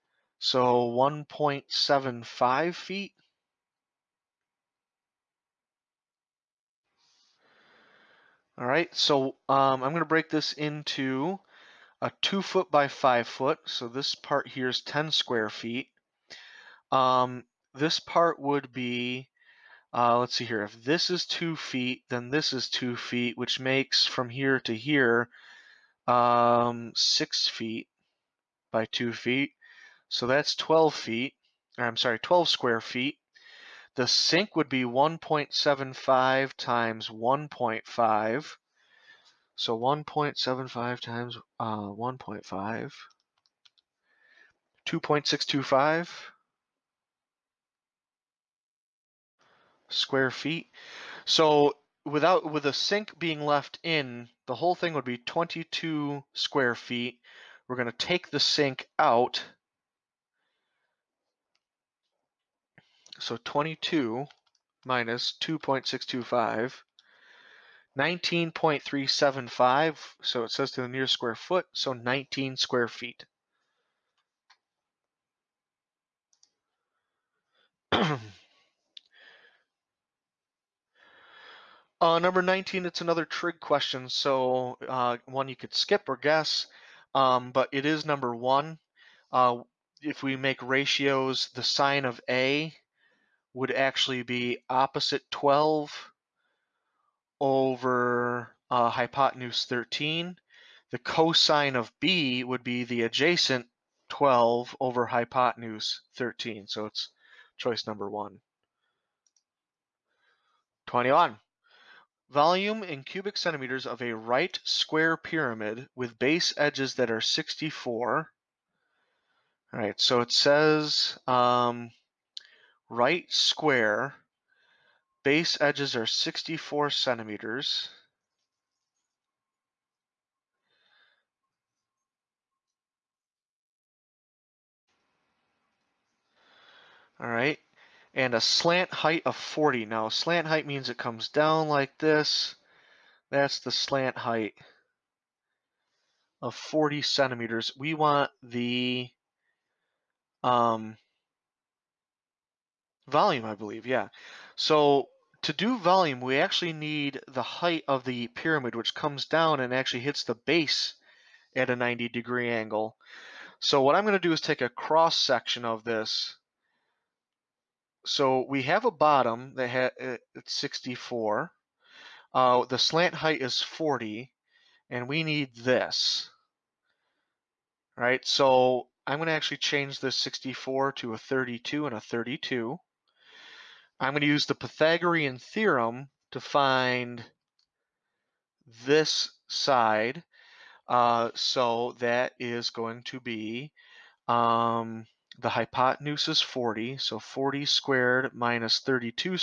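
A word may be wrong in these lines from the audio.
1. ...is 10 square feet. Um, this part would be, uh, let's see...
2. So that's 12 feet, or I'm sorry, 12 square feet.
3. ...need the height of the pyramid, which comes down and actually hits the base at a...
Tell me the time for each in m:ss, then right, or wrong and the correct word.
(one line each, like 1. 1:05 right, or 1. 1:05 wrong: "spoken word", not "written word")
1. 0:14 right
2. 0:30 right
3. 2:36 right.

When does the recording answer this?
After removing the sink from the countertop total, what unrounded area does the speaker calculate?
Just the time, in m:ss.
1:07.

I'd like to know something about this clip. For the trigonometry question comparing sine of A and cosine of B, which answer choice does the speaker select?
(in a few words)
choice number one.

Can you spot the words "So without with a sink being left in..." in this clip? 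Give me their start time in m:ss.
0:51.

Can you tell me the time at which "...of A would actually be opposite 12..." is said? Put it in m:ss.
1:32.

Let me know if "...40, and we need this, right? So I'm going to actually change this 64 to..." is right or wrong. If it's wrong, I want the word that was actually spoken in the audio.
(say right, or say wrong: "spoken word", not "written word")
right.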